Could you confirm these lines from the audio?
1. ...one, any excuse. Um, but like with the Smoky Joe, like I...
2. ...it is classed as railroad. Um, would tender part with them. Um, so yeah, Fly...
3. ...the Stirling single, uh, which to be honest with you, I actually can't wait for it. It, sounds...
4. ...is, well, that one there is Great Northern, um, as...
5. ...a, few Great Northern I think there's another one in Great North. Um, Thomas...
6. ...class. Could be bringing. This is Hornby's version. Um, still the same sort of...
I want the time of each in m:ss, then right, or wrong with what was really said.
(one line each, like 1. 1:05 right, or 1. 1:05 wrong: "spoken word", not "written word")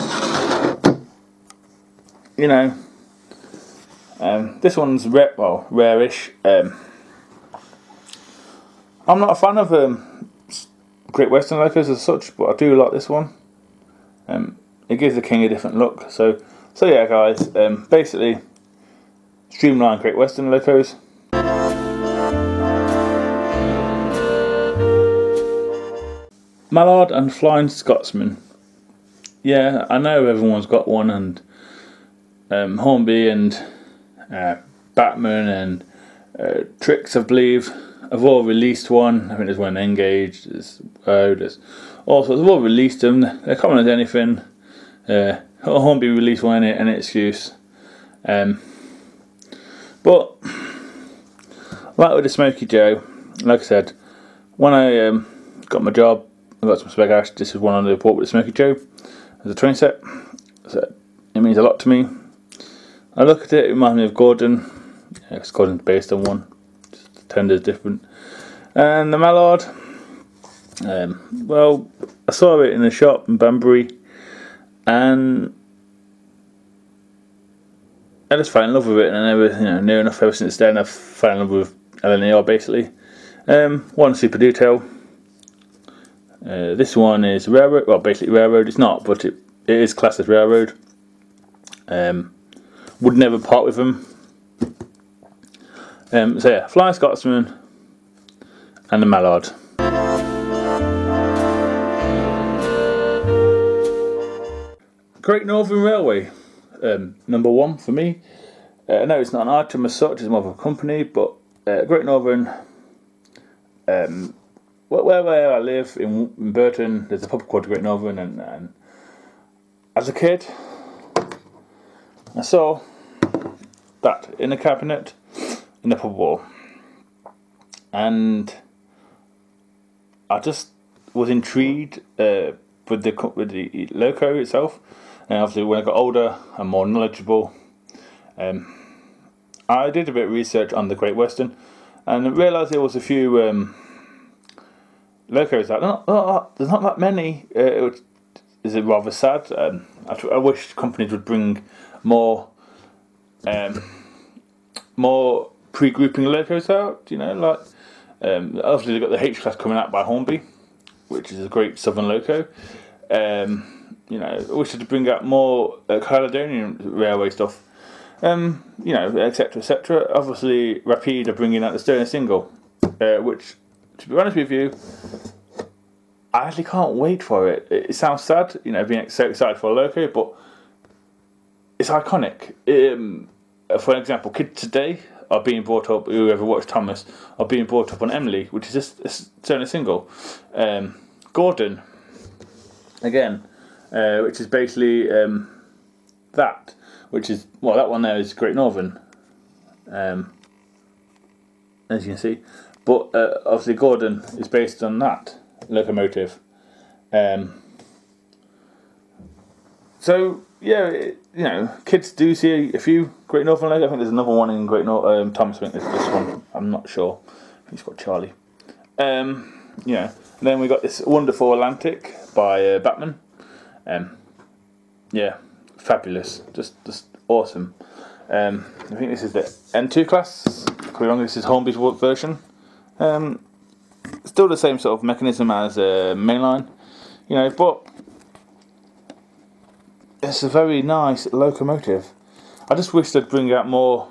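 1. 0:46 right
2. 1:29 wrong: "never", not "tender"
3. 2:51 right
4. 3:17 right
5. 3:32 right
6. 3:50 wrong: "wrong", not "bringing".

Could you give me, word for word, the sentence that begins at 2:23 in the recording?
Um, Loco is like, oh, oh, oh, there's not that many.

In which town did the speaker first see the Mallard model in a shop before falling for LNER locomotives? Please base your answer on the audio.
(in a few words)
Banbury.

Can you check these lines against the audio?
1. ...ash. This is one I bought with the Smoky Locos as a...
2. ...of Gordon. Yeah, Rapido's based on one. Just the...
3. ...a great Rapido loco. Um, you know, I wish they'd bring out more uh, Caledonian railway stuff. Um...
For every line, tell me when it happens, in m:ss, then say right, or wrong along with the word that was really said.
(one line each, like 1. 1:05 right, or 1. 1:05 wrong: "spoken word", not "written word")
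1. 0:57 wrong: "Joe", not "Locos"
2. 1:04 wrong: "Gordon", not "Rapido"
3. 2:41 wrong: "Southern", not "Rapido".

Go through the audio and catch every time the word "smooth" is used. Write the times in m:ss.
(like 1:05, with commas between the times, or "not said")
not said.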